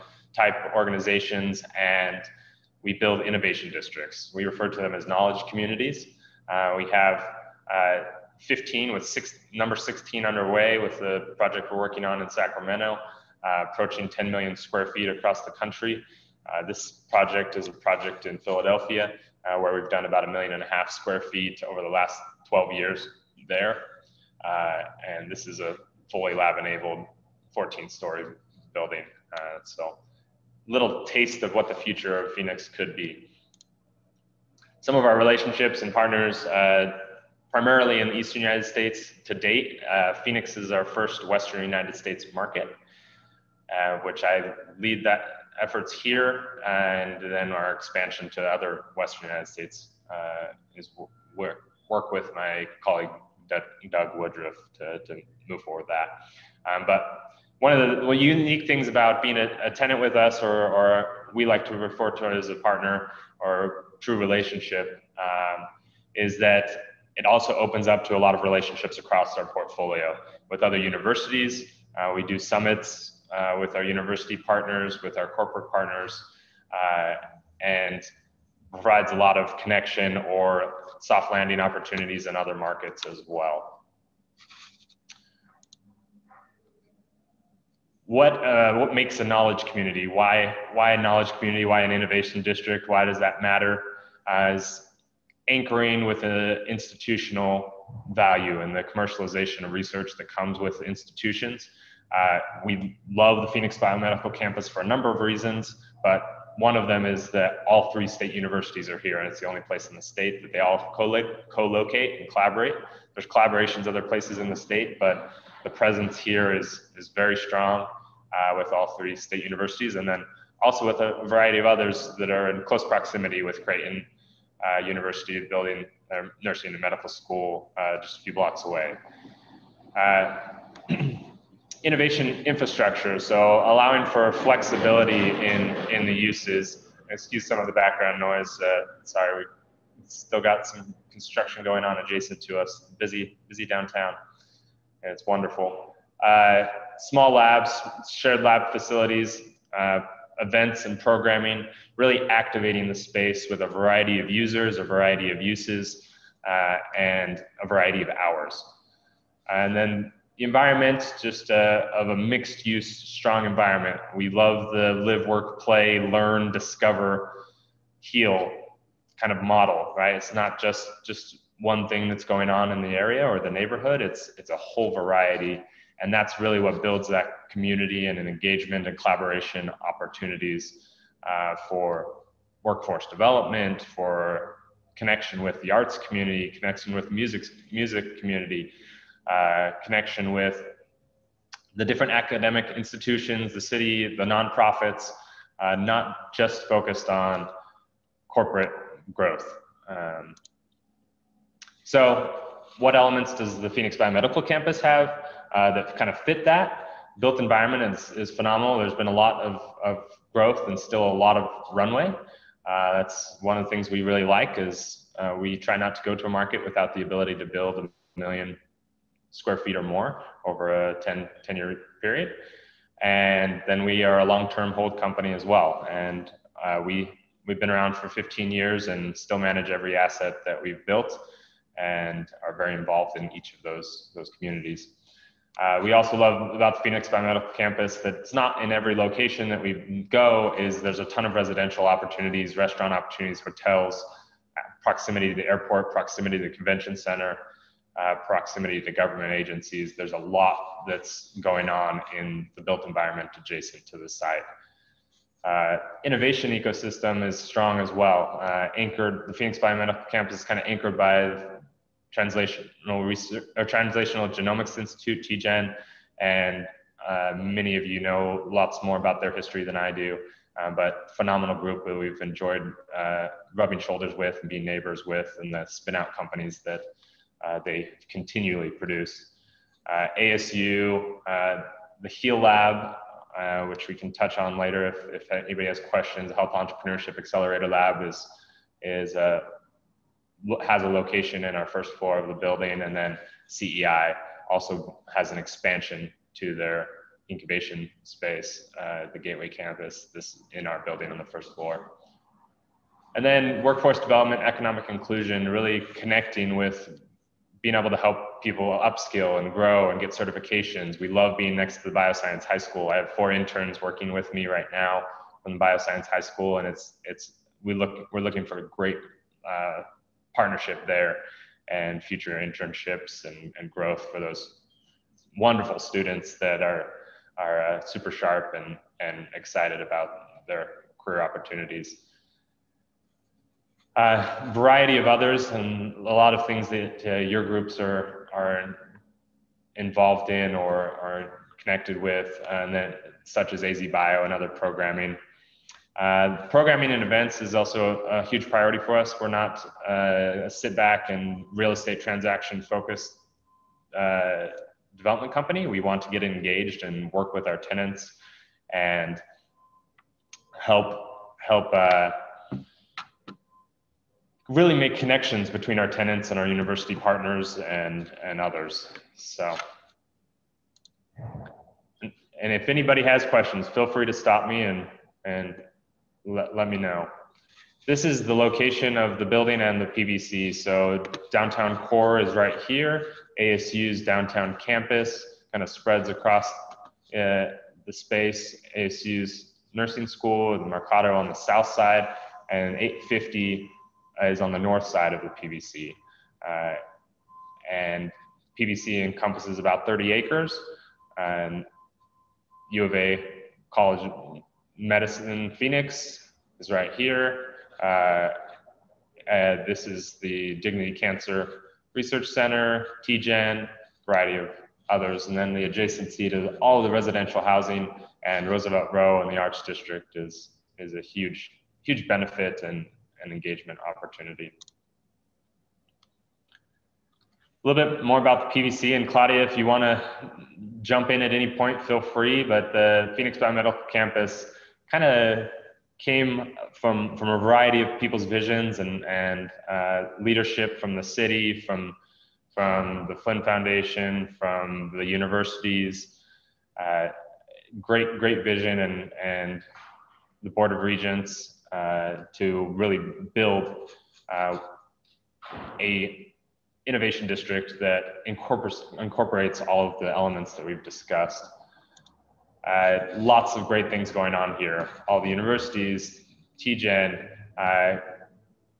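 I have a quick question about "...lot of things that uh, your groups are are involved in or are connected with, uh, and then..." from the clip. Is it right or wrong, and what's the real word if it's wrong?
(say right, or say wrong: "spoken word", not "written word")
right.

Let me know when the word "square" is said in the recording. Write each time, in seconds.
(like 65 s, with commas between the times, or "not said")
14 s, 20 s, 219 s.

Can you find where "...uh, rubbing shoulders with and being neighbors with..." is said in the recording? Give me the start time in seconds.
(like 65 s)
272 s.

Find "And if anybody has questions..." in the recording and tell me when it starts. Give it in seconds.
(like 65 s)
372 s.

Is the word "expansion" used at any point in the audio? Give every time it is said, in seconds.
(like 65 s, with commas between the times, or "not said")
47 s, 295 s.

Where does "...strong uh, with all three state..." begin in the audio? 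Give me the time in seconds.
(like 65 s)
117 s.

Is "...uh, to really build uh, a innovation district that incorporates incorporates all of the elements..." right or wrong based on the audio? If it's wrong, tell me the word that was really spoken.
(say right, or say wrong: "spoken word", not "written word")
right.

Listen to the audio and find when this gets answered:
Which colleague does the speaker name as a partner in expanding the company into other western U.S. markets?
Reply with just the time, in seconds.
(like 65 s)
53 s.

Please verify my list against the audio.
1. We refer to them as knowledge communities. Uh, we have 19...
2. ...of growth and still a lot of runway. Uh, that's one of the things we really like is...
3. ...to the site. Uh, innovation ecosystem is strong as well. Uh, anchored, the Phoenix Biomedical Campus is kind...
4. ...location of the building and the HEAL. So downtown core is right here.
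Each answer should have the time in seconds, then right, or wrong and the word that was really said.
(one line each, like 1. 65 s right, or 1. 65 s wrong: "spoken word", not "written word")
1. 4 s wrong: "15", not "19"
2. 209 s right
3. 253 s right
4. 378 s wrong: "PBC", not "HEAL".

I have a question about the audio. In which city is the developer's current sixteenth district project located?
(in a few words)
Sacramento.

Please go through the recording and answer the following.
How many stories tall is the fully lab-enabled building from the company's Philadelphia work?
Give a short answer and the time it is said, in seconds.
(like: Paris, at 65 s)
14, at 27 s.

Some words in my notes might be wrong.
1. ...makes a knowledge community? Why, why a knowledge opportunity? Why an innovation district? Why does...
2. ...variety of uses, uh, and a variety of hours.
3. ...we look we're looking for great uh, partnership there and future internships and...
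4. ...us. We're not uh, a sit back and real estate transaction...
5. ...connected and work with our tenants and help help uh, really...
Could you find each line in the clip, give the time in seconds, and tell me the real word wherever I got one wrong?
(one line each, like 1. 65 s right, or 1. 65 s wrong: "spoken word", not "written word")
1. 88 s wrong: "community", not "opportunity"
2. 154 s right
3. 317 s right
4. 348 s right
5. 356 s wrong: "engaged", not "connected".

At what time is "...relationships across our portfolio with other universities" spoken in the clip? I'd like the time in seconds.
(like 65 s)
68 s.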